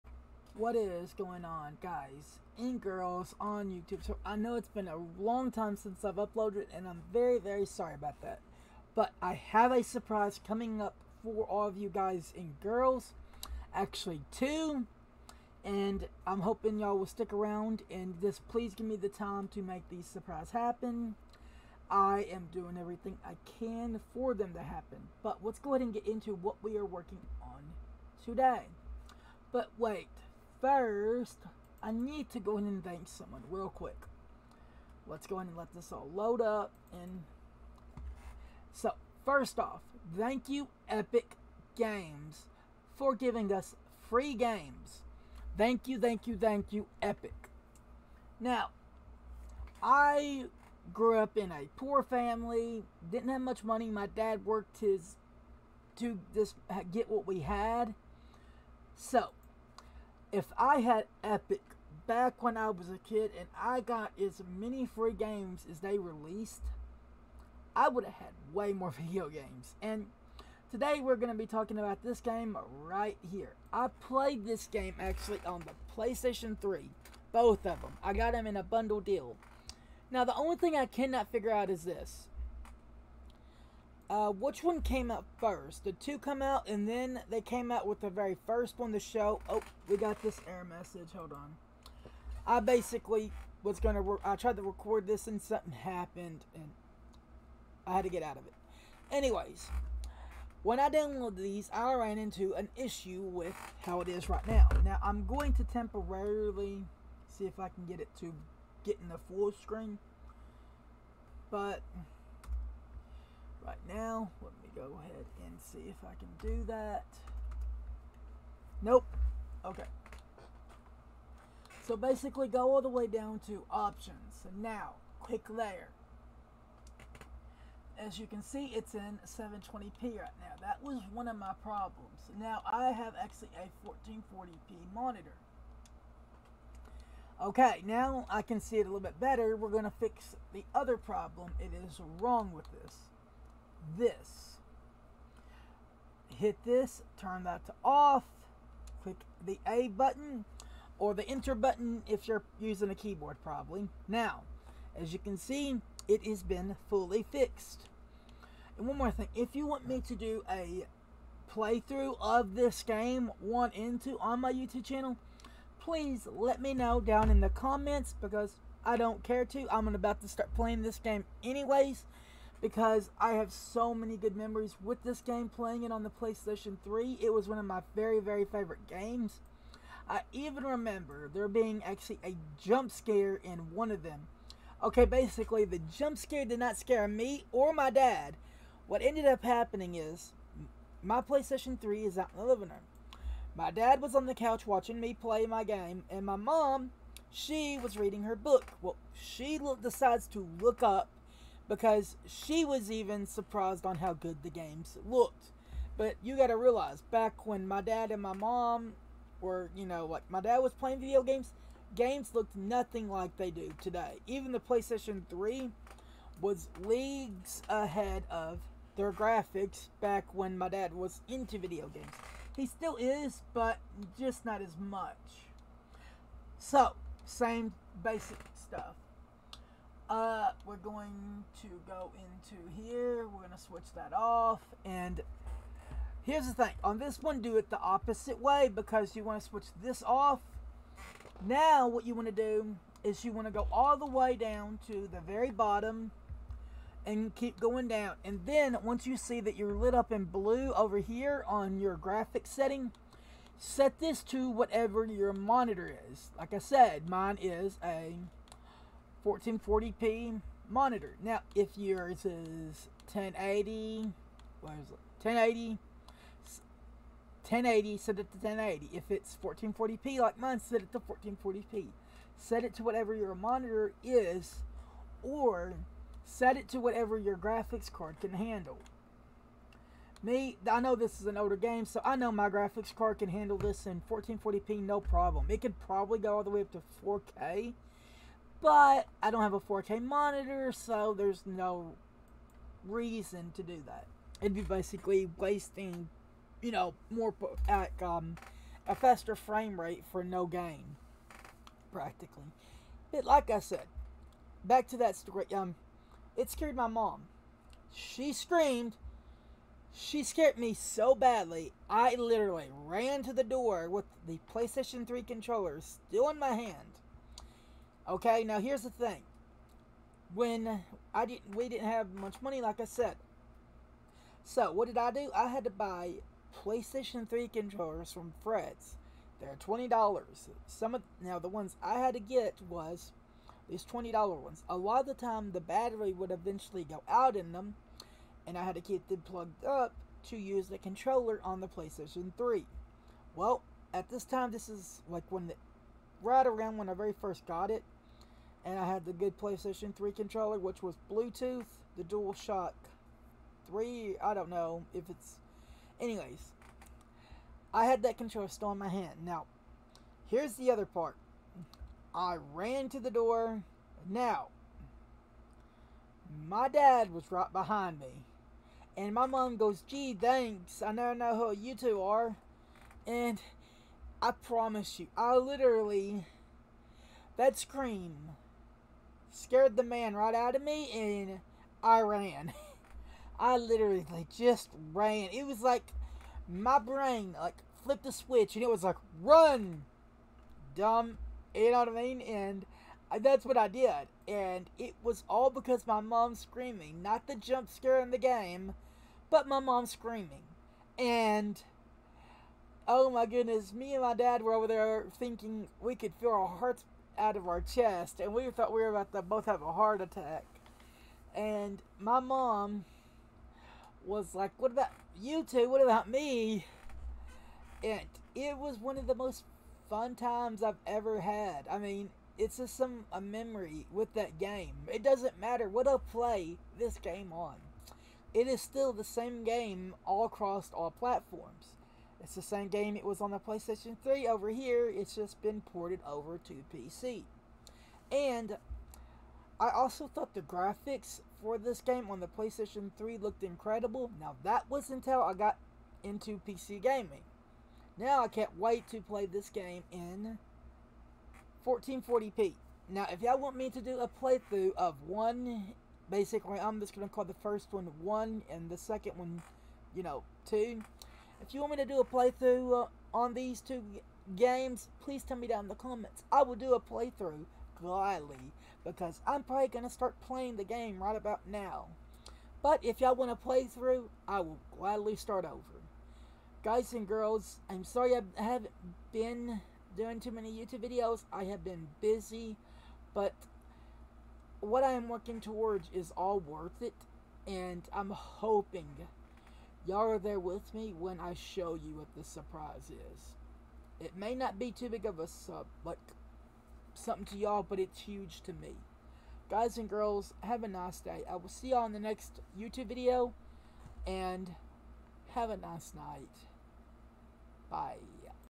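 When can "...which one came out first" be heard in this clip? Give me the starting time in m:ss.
1:24.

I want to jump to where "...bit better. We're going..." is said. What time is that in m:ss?
2:18.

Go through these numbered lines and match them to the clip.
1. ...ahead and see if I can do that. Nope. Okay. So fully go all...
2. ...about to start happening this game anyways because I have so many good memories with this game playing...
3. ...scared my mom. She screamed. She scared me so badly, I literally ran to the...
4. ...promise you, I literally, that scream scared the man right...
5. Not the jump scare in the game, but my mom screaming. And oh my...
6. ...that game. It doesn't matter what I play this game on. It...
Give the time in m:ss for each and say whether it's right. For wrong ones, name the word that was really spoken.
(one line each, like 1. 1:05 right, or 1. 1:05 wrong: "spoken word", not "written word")
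1. 1:54 wrong: "basically", not "fully"
2. 2:49 wrong: "playing", not "happening"
3. 5:06 right
4. 6:14 right
5. 6:37 right
6. 7:04 right.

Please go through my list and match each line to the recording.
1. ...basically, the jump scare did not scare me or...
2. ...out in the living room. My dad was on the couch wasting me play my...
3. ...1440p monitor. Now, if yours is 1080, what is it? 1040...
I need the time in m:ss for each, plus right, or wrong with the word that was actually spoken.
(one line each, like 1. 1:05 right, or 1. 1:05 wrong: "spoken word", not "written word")
1. 3:05 right
2. 3:12 wrong: "watching", not "wasting"
3. 4:19 wrong: "1080", not "1040".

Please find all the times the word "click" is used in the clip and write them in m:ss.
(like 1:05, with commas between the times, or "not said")
2:05, 2:29.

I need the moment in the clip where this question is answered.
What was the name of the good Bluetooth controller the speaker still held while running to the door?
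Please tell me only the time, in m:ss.
5:52.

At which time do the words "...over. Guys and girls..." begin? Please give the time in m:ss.
7:55.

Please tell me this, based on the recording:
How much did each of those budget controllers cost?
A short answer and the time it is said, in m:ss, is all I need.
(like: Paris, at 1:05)
$20, at 5:29.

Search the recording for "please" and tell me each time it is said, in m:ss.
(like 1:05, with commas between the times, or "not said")
0:18, 2:45, 7:45.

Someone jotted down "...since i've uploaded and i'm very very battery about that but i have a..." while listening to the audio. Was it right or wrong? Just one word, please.
wrong.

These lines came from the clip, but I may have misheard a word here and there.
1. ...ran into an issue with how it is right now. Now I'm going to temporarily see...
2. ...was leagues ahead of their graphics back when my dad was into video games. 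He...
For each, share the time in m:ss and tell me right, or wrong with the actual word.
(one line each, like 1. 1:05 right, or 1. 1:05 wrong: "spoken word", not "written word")
1. 1:41 right
2. 3:36 right.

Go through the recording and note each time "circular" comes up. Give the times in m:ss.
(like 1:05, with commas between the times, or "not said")
not said.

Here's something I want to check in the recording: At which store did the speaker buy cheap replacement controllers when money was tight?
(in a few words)
Fred's.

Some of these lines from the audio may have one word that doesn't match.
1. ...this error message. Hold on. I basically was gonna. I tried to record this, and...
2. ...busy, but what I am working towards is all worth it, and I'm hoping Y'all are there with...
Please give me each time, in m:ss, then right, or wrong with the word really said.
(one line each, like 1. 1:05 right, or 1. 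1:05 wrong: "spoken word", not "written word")
1. 1:30 right
2. 8:02 right.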